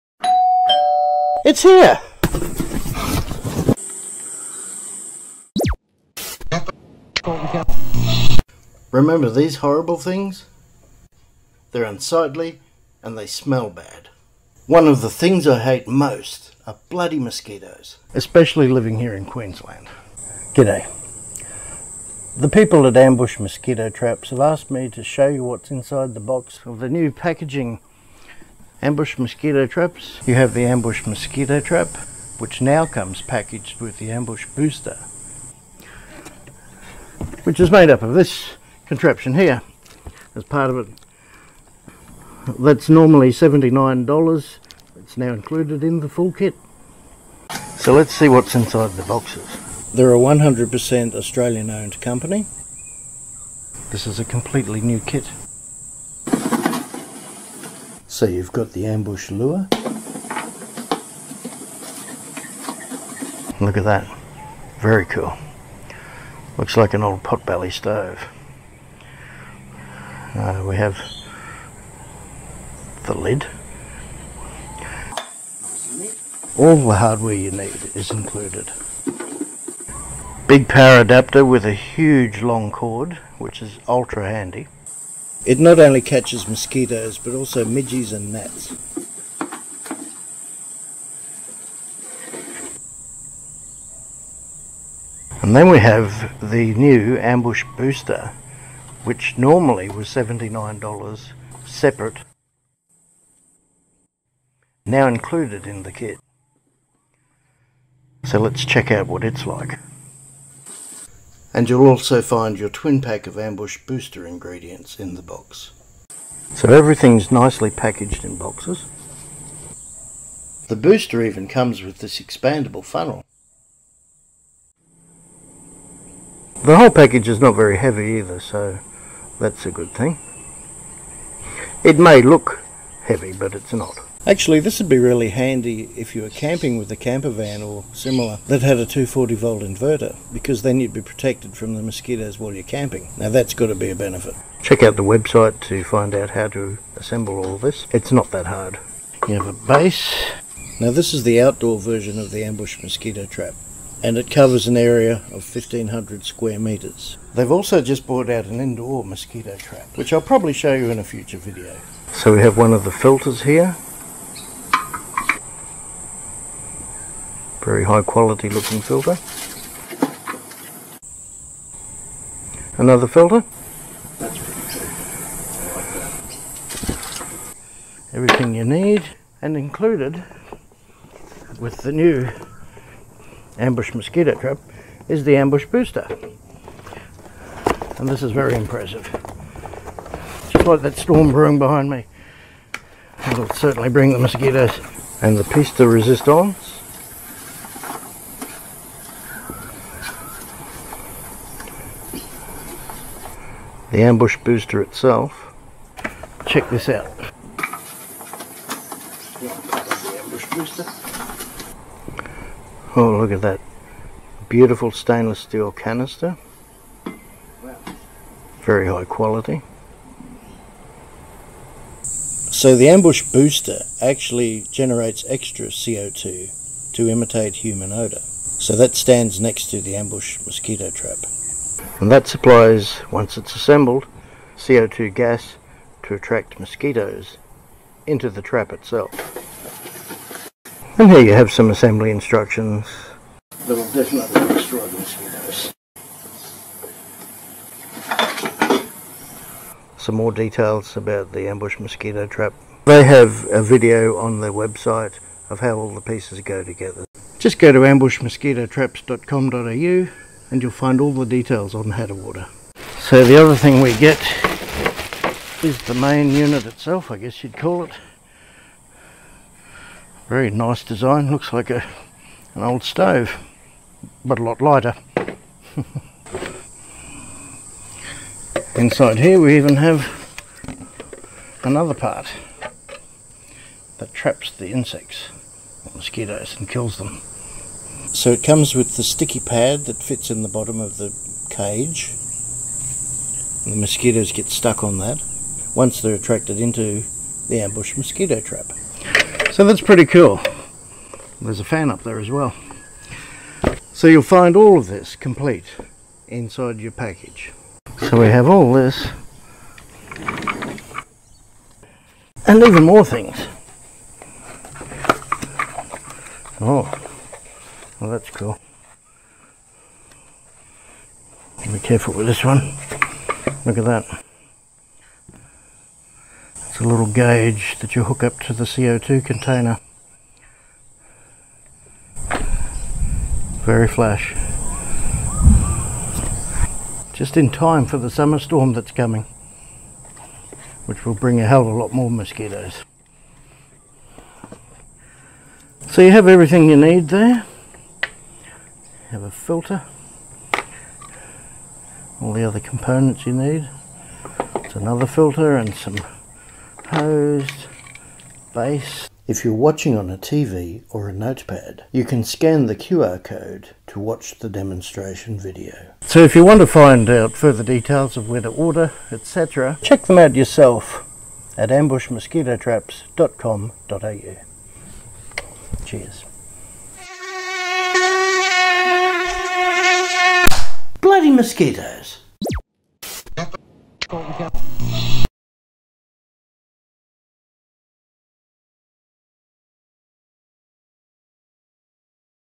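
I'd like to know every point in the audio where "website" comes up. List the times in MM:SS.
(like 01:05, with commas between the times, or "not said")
02:25, 04:14.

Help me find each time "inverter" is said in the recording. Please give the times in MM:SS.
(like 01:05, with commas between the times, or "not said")
02:19.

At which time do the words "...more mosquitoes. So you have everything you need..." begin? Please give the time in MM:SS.
05:41.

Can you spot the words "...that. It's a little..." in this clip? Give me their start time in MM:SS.
05:23.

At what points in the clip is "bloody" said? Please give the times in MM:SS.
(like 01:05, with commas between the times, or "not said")
00:16, 06:21.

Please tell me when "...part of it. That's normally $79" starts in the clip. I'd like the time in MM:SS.
00:40.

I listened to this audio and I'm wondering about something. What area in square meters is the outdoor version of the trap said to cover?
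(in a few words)
1500 square meters.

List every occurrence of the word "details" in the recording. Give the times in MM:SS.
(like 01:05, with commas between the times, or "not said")
04:10, 04:21, 06:07.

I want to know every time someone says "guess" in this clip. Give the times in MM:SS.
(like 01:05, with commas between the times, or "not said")
04:27.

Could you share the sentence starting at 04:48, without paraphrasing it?
So it comes with the sticky pad that fits in the bottom of the cage.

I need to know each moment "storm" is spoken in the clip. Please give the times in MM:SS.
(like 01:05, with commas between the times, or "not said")
03:10, 05:38.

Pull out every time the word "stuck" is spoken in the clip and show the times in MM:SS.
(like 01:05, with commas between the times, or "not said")
04:54.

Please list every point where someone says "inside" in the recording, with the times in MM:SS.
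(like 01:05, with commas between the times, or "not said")
00:25, 00:48, 04:38, 05:06.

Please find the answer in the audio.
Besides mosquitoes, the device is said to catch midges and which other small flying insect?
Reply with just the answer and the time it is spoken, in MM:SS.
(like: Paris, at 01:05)
Gnats, at 01:28.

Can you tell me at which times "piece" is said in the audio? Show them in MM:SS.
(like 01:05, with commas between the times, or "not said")
03:15, 04:16.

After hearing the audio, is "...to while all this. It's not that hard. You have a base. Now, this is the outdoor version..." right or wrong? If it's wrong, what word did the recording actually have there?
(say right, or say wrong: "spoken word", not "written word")
wrong: "assemble", not "while".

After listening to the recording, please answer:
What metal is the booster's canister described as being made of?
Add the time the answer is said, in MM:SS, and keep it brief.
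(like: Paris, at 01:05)
Stainless steel, at 03:34.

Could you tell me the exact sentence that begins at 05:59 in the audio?
If you're watching on a TV or a notepad, you can scan the QR code to watch the demonstration video.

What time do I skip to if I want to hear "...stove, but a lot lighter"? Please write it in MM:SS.
04:32.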